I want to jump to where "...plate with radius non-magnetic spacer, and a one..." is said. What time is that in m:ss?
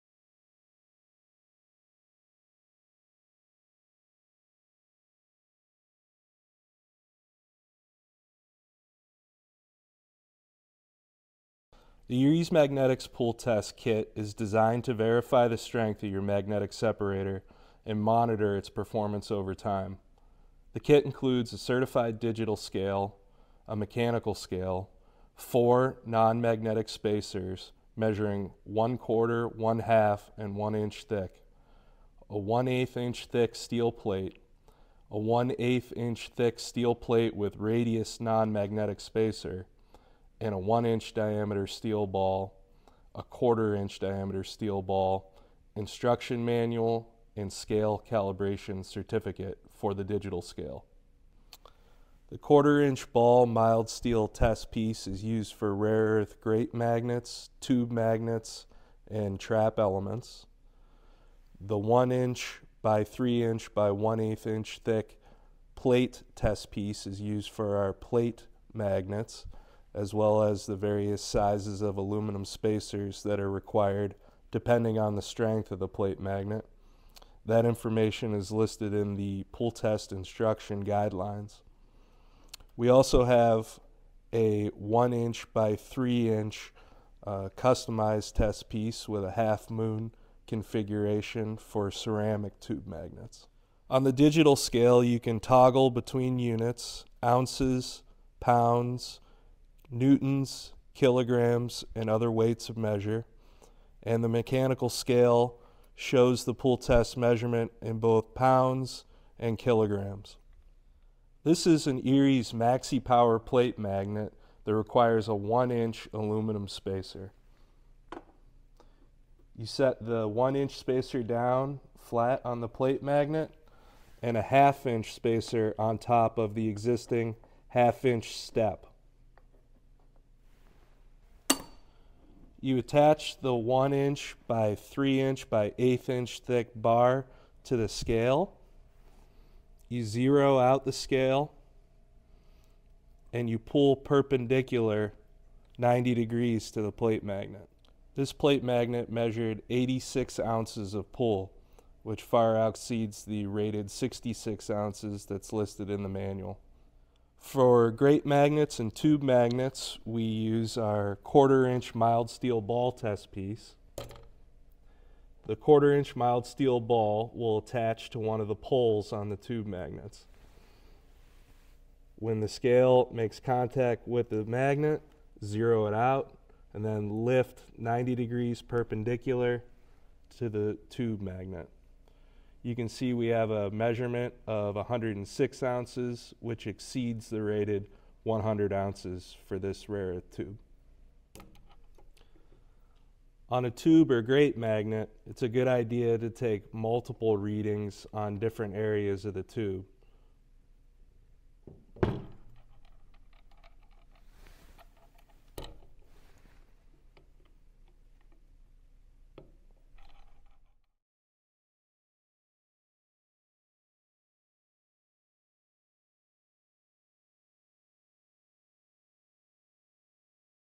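0:36.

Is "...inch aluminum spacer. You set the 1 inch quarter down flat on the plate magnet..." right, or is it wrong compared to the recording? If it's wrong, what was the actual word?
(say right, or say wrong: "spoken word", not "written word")
wrong: "spacer", not "quarter".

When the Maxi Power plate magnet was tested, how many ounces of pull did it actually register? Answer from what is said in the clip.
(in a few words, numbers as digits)
86 ounces.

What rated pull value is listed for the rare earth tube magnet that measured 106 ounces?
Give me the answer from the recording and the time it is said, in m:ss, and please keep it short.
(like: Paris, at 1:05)
100 ounces, at 3:08.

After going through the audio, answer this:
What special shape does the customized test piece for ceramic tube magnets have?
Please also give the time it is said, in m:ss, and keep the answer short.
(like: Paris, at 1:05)
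Half moon, at 1:29.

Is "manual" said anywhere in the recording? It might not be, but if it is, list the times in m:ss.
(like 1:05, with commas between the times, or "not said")
0:46, 2:36.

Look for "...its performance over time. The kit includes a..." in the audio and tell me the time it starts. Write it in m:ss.
0:18.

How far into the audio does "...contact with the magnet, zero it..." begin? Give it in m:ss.
2:53.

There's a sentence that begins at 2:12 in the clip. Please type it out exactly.
You attach the one inch by three inch by eighth inch thick bar to the scale.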